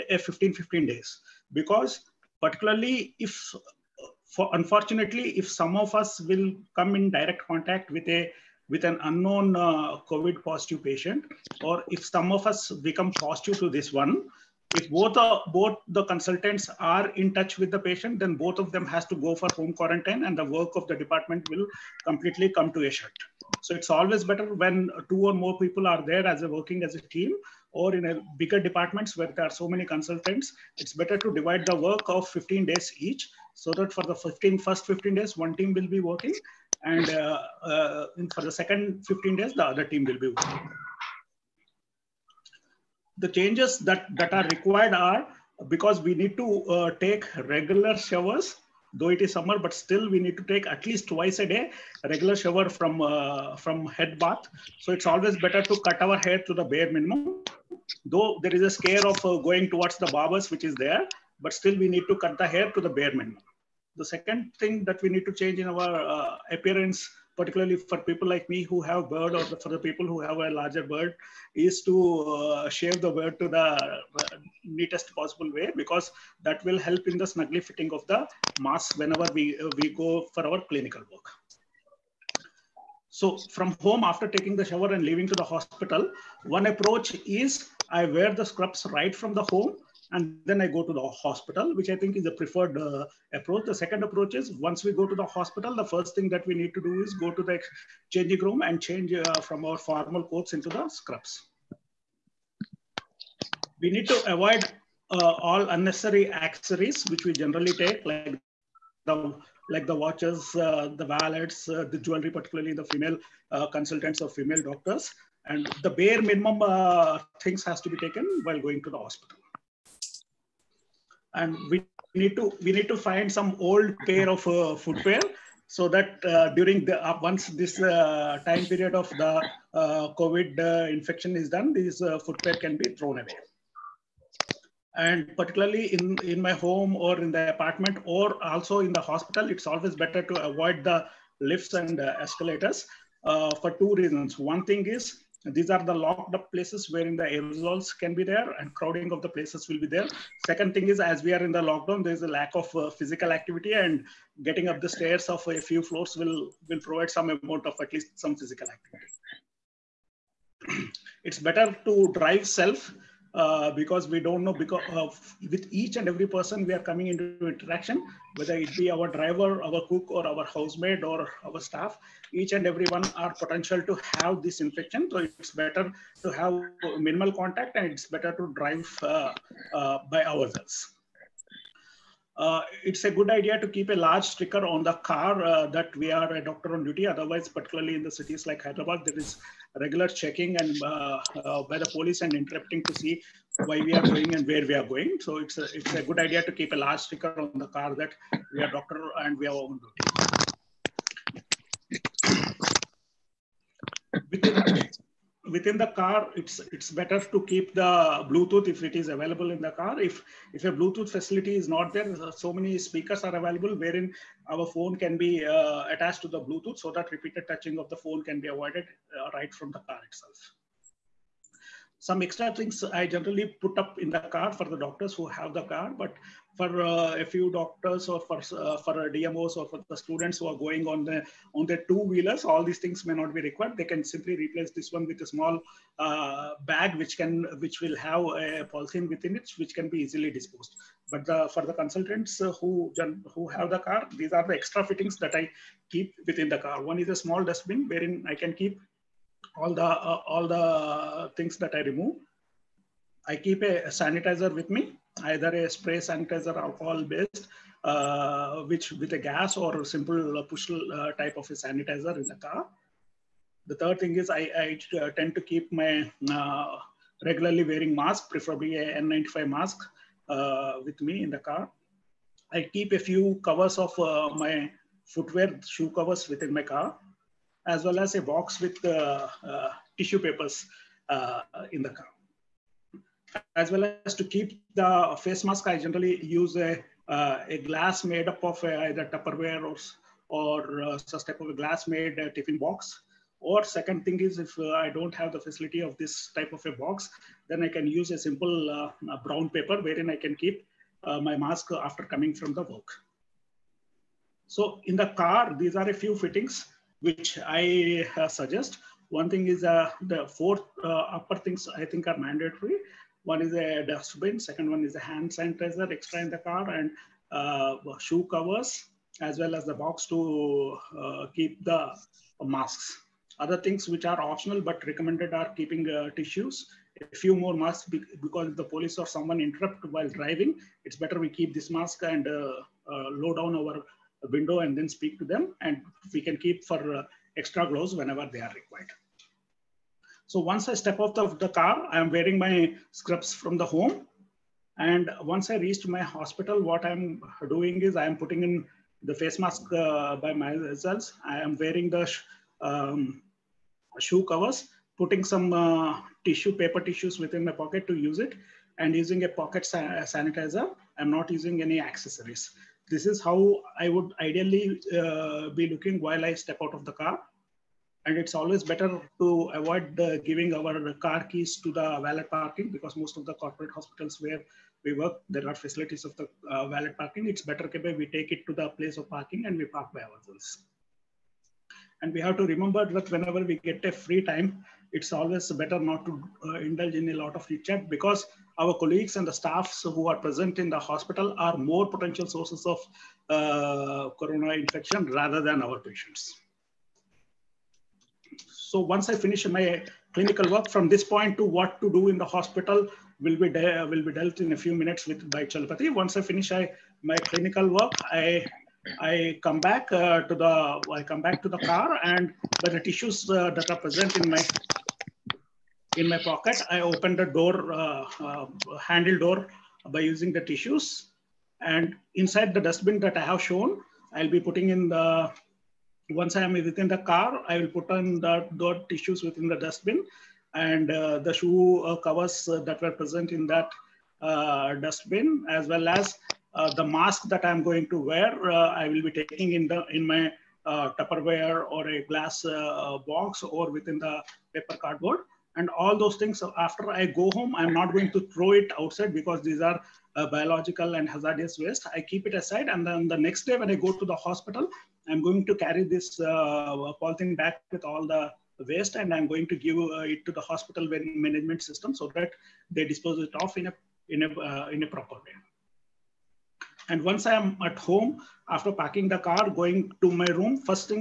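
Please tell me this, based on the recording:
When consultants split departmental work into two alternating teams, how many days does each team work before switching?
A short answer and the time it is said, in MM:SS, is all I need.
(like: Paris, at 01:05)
15, at 00:32.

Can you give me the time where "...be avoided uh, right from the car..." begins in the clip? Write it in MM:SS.
03:38.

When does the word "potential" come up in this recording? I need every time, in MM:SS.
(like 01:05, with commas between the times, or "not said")
02:53, 06:31.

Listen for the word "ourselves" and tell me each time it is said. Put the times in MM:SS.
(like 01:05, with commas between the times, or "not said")
03:00, 06:20.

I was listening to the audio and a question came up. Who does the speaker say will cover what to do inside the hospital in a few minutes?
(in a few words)
Chalpati.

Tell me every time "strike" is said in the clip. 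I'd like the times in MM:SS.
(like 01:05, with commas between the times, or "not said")
not said.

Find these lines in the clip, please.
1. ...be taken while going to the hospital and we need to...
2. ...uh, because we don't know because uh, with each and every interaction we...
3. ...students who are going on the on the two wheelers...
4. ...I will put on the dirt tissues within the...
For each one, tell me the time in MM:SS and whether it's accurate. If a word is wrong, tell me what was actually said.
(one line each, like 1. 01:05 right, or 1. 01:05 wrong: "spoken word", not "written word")
1. 01:57 right
2. 02:43 wrong: "person", not "interaction"
3. 03:49 right
4. 07:07 right.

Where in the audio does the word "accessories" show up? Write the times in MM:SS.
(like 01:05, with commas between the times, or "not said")
01:46, 06:01.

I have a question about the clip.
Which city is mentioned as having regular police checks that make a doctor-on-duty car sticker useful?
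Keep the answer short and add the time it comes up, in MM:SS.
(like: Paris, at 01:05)
Hyderabad, at 03:08.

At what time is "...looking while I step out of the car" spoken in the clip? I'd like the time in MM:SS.
06:05.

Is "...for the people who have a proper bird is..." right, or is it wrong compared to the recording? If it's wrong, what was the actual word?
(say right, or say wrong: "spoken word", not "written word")
wrong: "larger", not "proper".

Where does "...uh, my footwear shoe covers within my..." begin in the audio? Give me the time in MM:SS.
04:33.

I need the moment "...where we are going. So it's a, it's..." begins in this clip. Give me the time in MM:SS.
03:14.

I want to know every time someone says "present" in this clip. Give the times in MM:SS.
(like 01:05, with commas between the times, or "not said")
06:30, 06:53, 07:12.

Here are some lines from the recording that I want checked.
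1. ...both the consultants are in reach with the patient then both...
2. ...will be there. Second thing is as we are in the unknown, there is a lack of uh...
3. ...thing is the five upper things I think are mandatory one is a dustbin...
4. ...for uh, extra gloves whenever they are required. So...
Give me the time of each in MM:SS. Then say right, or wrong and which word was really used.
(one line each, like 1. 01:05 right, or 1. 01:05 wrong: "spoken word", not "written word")
1. 00:15 wrong: "touch", not "reach"
2. 02:29 wrong: "lockdown", not "unknown"
3. 05:09 wrong: "four", not "five"
4. 05:36 right.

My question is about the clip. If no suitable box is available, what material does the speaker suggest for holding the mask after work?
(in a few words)
brown paper.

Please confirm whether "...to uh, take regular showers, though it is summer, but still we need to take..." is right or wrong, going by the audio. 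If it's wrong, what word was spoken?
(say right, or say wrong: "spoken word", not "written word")
right.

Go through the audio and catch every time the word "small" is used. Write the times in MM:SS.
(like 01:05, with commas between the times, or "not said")
03:55, 04:07.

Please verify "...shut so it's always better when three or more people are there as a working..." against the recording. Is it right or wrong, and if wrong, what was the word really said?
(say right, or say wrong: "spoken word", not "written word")
wrong: "two", not "three".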